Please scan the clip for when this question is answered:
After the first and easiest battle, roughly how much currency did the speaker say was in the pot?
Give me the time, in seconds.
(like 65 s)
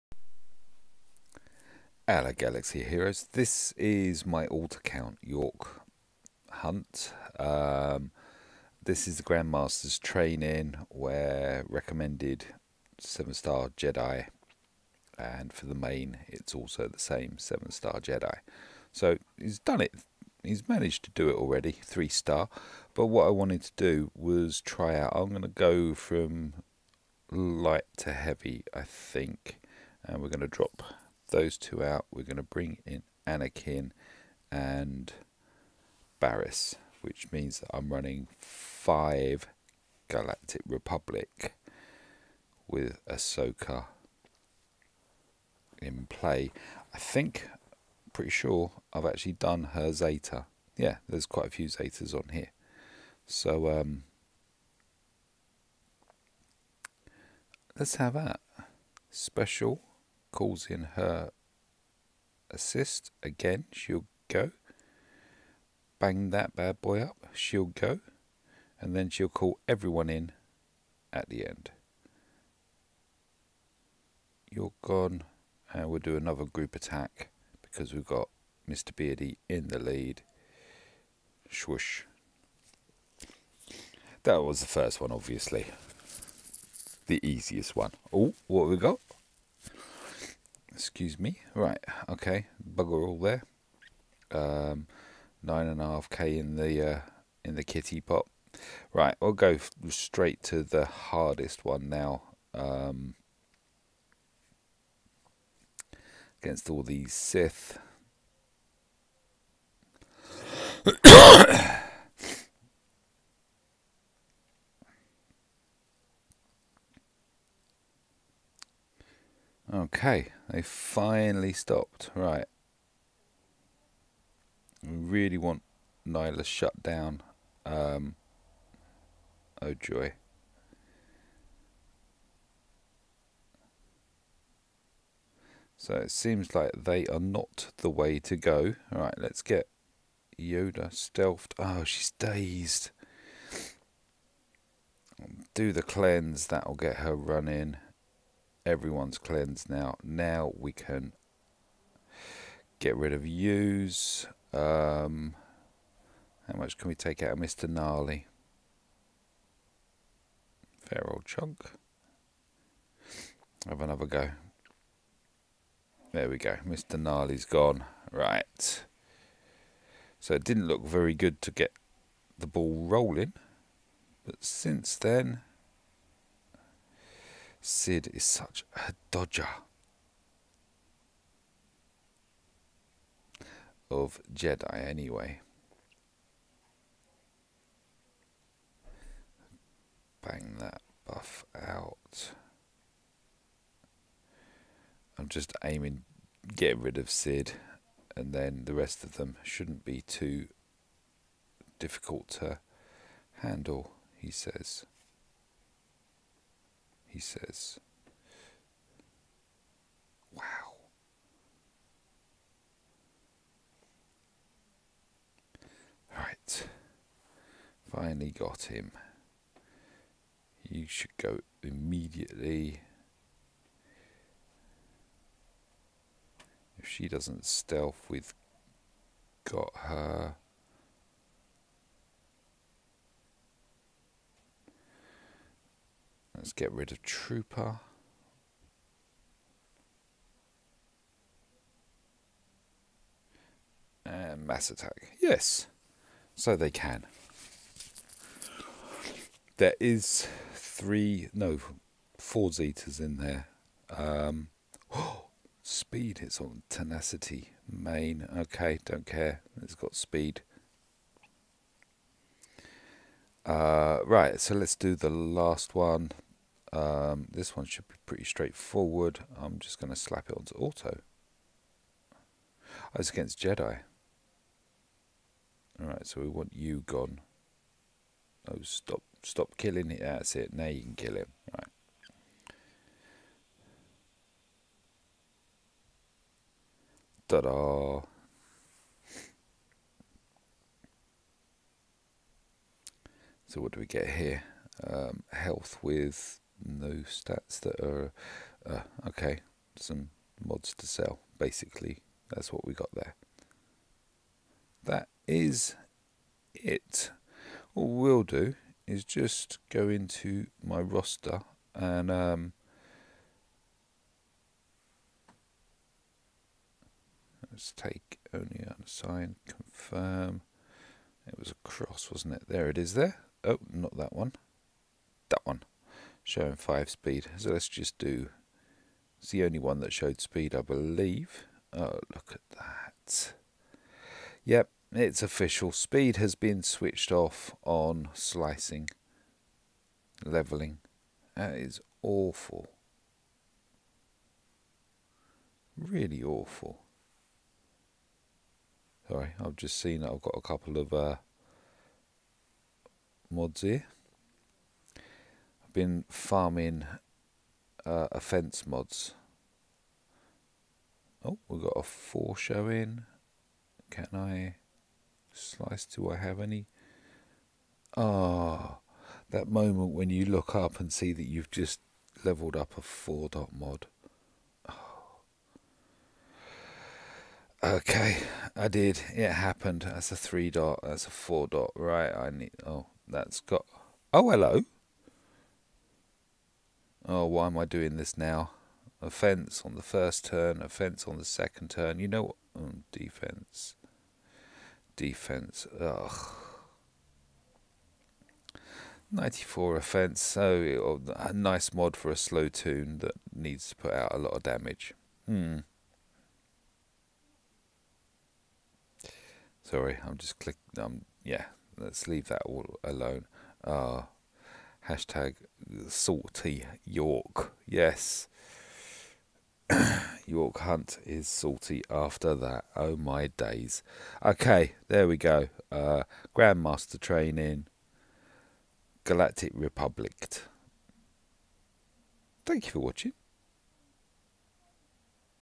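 95 s.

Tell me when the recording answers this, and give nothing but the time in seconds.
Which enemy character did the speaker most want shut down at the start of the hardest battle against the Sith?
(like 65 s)
126 s.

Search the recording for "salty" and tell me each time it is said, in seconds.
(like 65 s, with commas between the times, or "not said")
415 s, 421 s.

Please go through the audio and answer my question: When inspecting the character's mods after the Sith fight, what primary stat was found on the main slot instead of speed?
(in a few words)
Tenacity.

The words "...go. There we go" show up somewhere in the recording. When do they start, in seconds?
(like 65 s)
164 s.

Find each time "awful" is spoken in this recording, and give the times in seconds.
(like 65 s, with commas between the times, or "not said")
342 s, 346 s.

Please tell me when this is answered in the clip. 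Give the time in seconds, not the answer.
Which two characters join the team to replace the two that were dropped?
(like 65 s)
33 s.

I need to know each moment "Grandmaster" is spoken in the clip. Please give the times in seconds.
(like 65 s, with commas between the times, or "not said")
9 s, 426 s.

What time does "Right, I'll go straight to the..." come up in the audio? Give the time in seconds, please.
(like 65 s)
98 s.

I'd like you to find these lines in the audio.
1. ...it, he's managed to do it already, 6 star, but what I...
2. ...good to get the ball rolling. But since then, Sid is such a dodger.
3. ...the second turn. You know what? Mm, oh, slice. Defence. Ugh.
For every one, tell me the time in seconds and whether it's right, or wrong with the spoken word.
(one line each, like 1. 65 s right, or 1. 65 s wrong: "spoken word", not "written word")
1. 19 s wrong: "3", not "6"
2. 171 s right
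3. 391 s wrong: "defence", not "slice".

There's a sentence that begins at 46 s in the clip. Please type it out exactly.
I think, pretty sure, I've actually done her Zeta.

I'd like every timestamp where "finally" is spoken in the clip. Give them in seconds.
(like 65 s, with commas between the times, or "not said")
120 s, 217 s.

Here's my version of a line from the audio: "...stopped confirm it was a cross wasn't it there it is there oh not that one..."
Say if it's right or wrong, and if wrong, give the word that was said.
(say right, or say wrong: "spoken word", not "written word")
wrong: "unsigned", not "stopped".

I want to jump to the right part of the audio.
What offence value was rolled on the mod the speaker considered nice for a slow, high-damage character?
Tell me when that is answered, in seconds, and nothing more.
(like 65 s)
399 s.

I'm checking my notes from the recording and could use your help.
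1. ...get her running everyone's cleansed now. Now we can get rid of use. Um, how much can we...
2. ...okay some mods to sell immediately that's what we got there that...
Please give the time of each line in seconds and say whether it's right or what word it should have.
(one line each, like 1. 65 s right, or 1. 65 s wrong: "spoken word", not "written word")
1. 146 s right
2. 299 s wrong: "basically", not "immediately".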